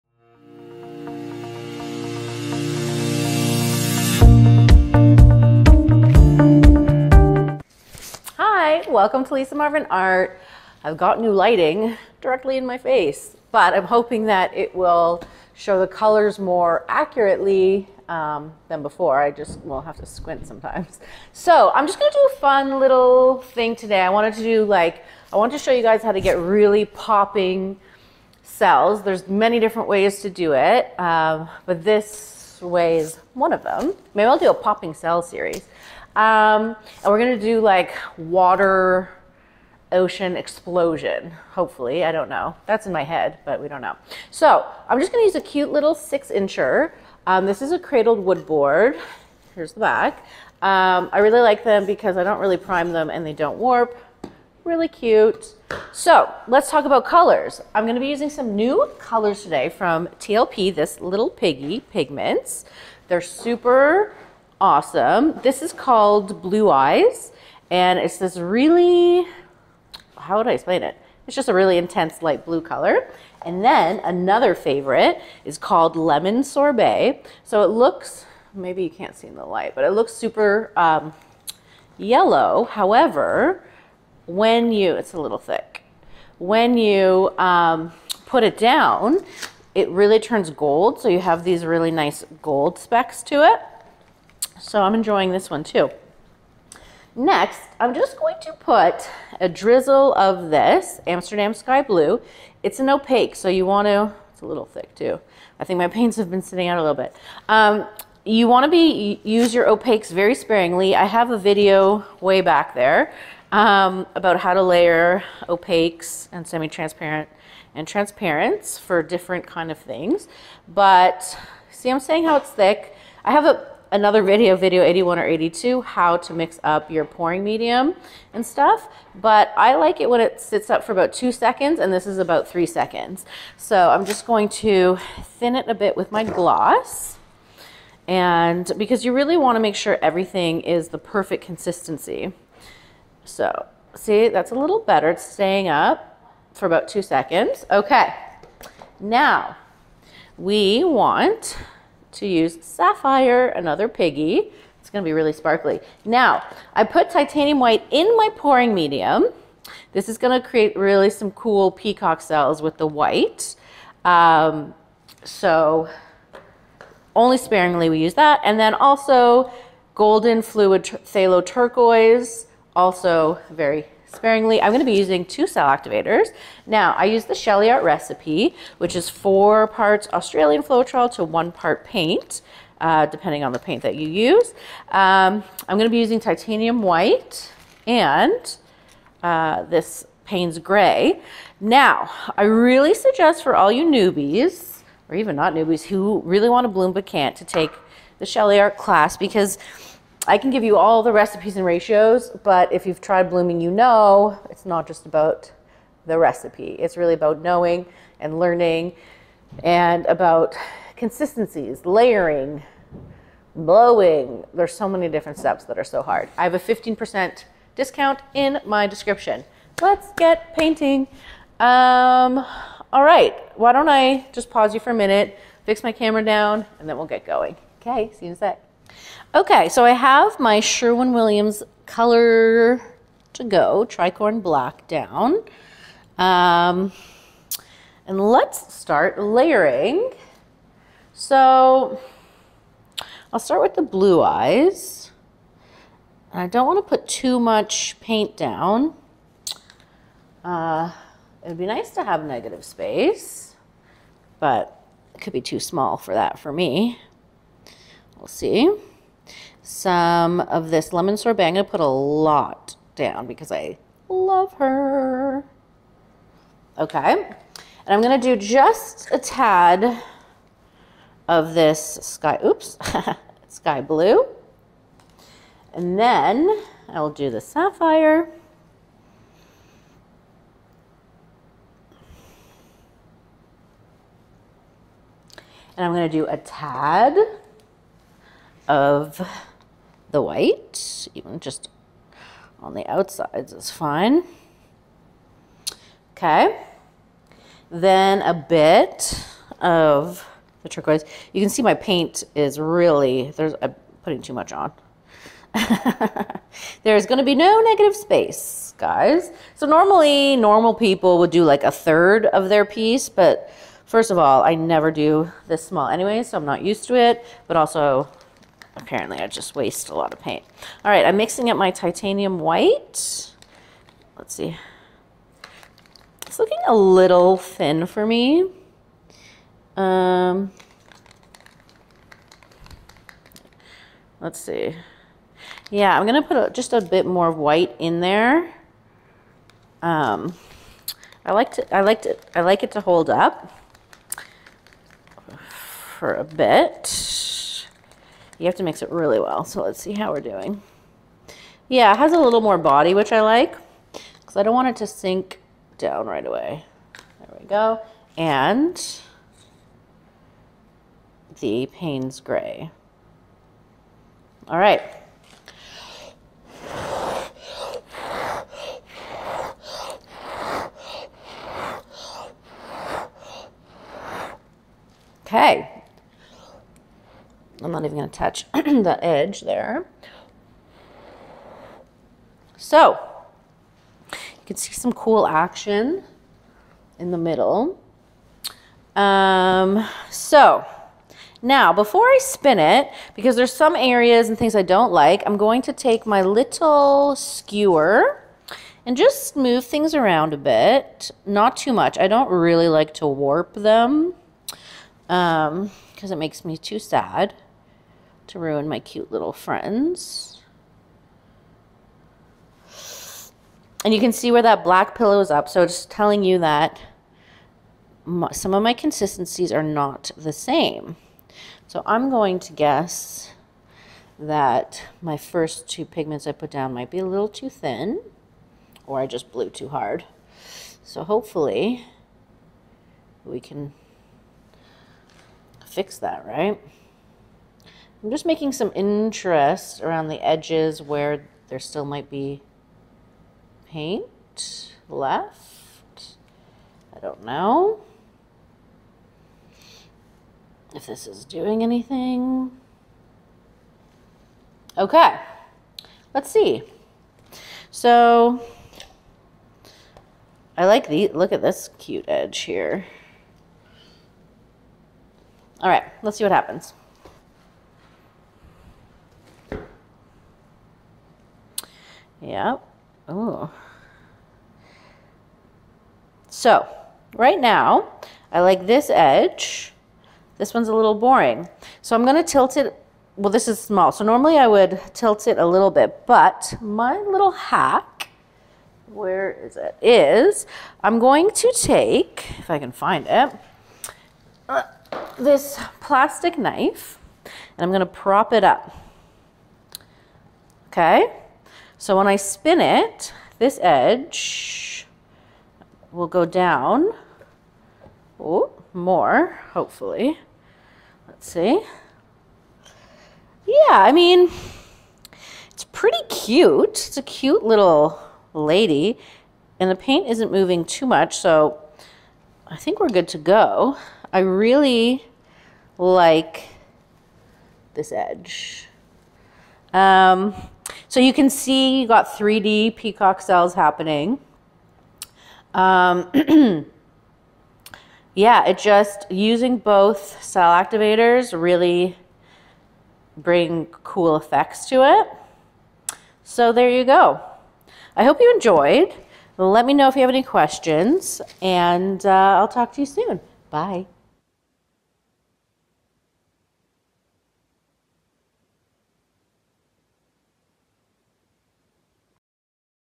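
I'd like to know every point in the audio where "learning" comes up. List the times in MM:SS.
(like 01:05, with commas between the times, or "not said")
03:28.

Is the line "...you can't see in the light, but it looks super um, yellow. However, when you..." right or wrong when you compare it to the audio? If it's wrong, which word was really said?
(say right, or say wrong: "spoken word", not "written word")
right.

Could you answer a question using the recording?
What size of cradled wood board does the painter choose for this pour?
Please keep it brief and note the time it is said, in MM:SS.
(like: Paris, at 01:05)
6 inch, at 00:45.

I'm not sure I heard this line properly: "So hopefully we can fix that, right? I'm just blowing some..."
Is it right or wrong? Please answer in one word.
wrong.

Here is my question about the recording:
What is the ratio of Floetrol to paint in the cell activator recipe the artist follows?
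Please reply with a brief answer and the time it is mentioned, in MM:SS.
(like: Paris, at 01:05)
4 to 1, at 02:59.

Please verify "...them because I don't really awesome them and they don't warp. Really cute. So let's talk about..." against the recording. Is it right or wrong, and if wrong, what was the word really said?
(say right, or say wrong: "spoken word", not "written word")
wrong: "prime", not "awesome".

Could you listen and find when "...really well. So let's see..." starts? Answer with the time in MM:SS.
05:48.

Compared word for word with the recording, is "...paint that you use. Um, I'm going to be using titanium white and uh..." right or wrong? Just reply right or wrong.
right.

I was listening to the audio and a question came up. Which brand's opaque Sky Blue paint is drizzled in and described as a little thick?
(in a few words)
Amsterdam.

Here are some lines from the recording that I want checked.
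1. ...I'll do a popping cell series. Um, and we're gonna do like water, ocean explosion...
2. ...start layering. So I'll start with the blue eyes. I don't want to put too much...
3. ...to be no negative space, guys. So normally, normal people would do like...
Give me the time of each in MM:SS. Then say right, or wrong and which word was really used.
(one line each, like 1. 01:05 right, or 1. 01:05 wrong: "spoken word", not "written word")
1. 00:34 right
2. 03:58 right
3. 05:07 right.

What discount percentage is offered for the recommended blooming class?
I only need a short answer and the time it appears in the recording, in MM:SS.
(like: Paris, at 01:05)
15%, at 03:36.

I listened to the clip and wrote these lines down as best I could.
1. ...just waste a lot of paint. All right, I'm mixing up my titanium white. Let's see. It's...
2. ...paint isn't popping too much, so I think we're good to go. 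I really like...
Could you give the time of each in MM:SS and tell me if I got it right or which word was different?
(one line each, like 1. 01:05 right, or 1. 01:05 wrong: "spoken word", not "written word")
1. 05:19 right
2. 08:39 wrong: "moving", not "popping".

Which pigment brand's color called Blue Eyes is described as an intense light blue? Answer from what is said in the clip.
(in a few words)
TLP.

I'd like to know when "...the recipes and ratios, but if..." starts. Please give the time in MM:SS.
03:21.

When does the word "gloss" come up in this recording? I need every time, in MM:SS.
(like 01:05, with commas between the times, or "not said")
02:16.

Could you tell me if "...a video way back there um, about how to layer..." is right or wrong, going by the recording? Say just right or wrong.
right.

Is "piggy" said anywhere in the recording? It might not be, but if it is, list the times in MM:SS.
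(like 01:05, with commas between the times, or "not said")
01:01, 02:33.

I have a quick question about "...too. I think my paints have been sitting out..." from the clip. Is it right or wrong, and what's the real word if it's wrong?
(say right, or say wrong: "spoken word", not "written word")
right.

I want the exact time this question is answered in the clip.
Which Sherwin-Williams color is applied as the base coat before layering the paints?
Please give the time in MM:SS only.
03:53.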